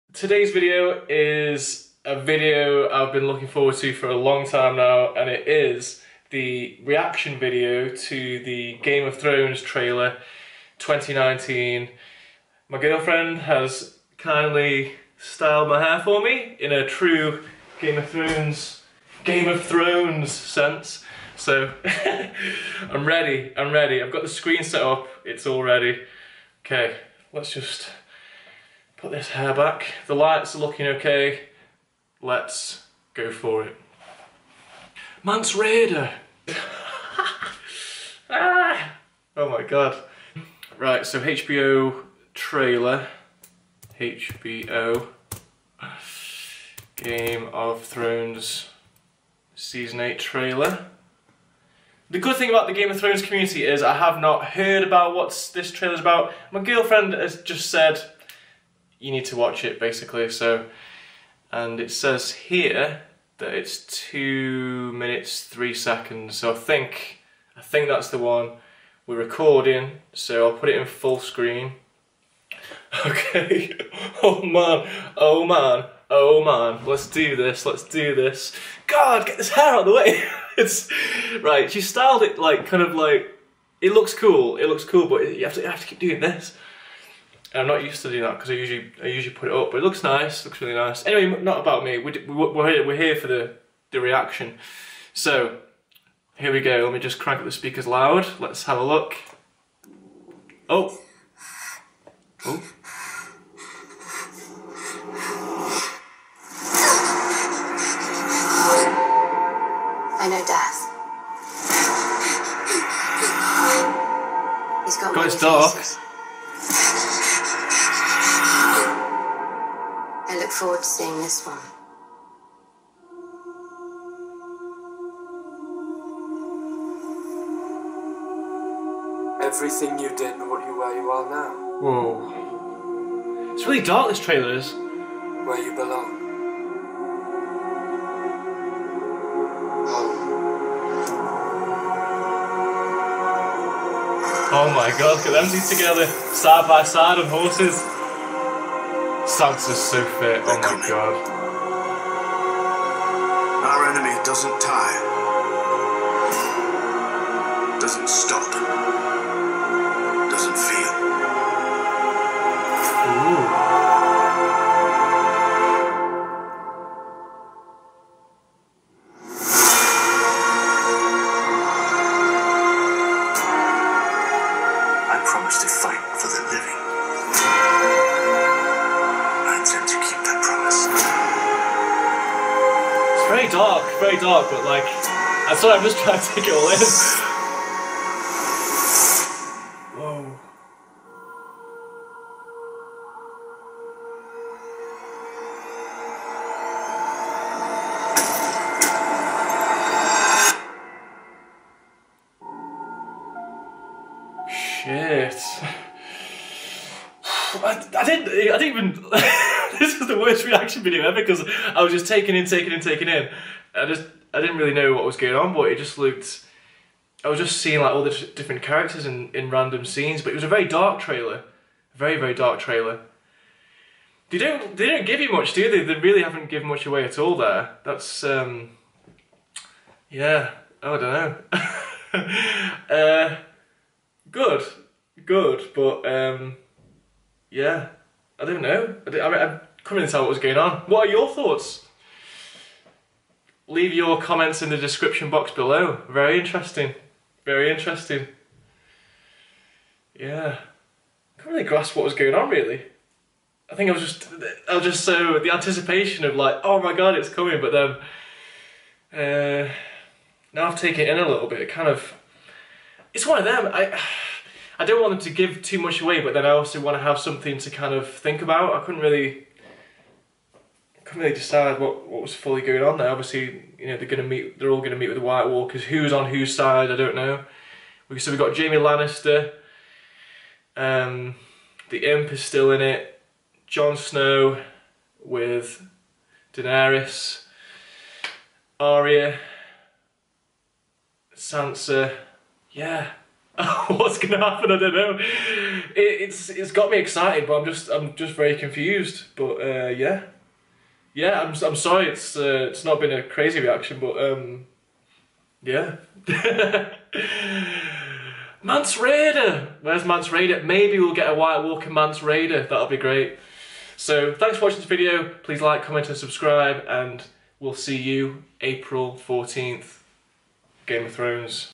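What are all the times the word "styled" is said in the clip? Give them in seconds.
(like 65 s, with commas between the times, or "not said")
15 s, 81 s.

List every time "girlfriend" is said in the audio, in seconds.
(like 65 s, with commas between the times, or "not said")
12 s, 56 s.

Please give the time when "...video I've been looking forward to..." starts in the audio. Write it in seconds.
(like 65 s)
2 s.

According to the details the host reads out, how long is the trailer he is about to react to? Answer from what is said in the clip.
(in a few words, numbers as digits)
2 minutes 3 seconds.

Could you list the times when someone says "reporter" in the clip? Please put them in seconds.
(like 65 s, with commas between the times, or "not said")
not said.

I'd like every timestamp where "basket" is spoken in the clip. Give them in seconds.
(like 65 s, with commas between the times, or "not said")
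not said.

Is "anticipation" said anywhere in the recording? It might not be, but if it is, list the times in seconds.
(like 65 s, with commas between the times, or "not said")
255 s.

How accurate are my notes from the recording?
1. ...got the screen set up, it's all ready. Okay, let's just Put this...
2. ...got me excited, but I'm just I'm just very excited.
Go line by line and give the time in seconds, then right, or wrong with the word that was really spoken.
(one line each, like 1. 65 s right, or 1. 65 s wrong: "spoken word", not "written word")
1. 24 s right
2. 296 s wrong: "confused", not "excited".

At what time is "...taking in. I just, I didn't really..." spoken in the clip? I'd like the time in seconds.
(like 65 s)
212 s.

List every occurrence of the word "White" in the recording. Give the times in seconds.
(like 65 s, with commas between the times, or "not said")
275 s, 311 s.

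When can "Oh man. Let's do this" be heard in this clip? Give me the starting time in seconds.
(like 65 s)
76 s.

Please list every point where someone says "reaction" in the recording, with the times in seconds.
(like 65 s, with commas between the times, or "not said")
6 s, 93 s, 210 s, 303 s.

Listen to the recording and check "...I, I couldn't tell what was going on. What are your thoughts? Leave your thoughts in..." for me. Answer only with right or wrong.
wrong.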